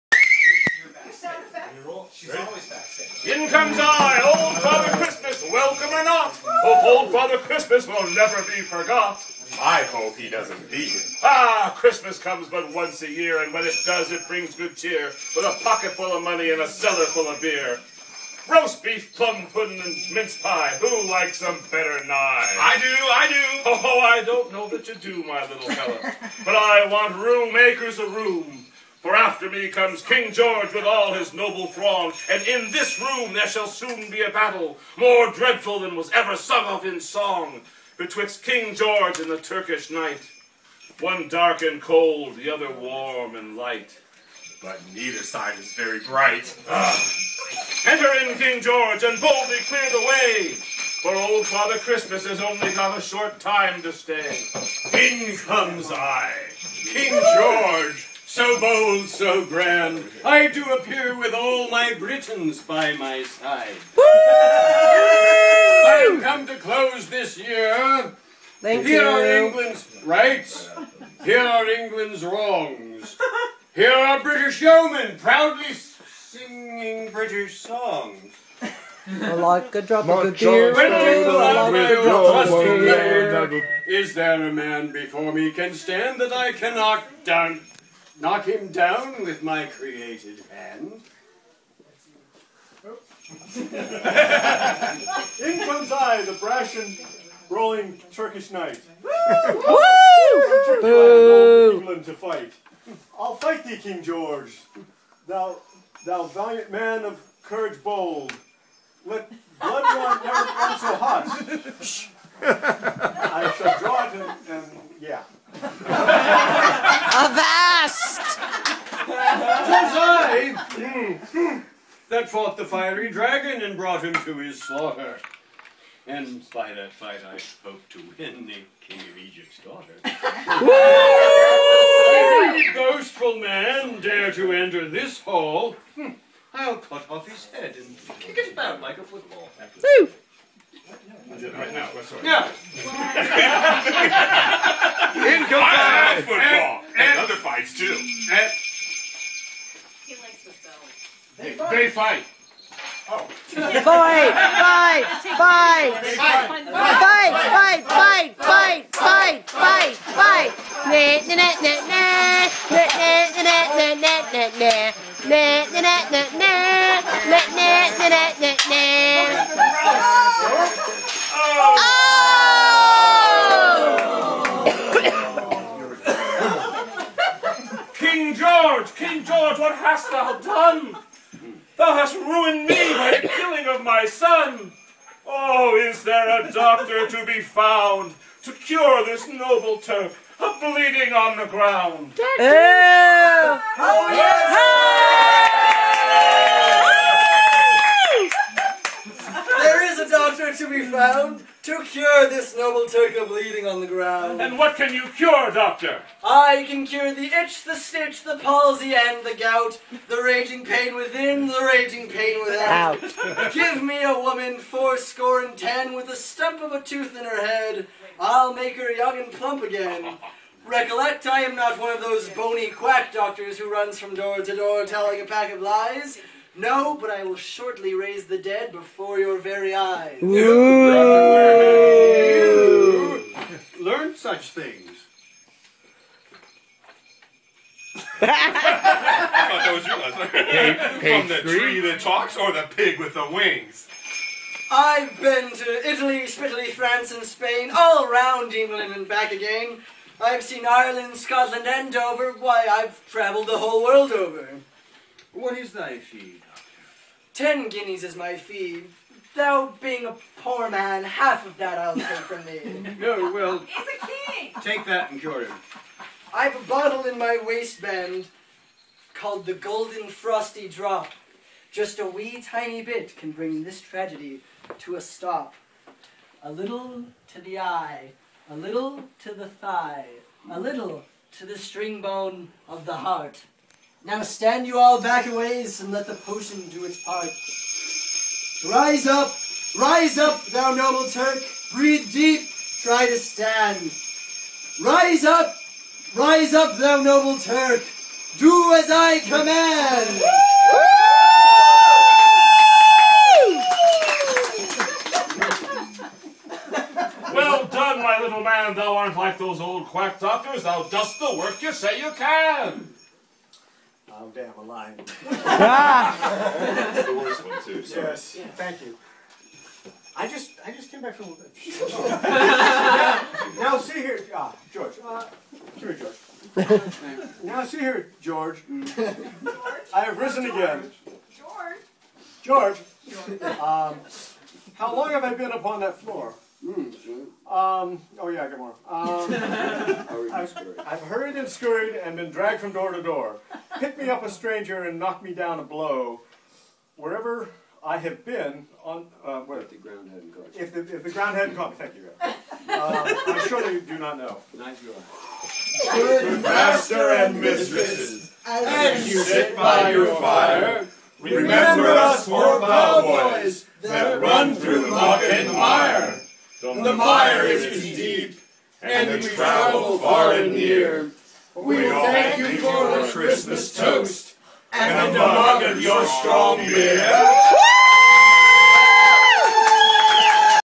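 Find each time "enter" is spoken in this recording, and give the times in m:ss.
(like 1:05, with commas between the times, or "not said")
0:47, 2:14.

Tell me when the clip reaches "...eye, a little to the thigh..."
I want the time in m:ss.
4:37.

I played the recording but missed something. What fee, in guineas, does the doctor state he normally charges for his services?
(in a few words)
10 guineas.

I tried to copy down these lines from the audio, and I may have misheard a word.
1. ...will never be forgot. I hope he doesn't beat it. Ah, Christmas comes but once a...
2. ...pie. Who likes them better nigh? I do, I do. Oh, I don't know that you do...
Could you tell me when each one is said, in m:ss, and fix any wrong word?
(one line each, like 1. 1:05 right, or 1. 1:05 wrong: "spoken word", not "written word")
1. 0:07 right
2. 0:20 right.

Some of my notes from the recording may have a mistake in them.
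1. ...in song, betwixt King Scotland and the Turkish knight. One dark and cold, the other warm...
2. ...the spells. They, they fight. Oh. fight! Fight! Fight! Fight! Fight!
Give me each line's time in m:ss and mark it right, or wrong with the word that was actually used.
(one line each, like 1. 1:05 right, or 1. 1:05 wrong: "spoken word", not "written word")
1. 0:36 wrong: "George", not "Scotland"
2. 2:30 right.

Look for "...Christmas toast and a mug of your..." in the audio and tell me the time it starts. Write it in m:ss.
6:13.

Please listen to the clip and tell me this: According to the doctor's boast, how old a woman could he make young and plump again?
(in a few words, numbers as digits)
90 (fourscore and ten).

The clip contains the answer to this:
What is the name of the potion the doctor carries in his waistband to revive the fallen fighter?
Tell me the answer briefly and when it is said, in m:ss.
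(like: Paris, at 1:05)
Golden Frosty Drop, at 4:29.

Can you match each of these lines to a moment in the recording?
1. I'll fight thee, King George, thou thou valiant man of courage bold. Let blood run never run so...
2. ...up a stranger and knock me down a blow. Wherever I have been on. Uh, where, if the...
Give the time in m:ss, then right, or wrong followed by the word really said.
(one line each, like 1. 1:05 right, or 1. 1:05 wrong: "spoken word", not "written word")
1. 1:43 right
2. 5:44 right.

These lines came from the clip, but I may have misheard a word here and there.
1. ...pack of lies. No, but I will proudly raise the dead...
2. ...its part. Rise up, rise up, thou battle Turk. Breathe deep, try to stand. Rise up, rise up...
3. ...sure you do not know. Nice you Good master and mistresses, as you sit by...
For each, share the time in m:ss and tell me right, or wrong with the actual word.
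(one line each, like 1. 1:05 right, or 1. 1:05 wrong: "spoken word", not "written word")
1. 3:45 wrong: "shortly", not "proudly"
2. 4:46 wrong: "noble", not "battle"
3. 5:53 right.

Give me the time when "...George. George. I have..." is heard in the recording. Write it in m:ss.
5:28.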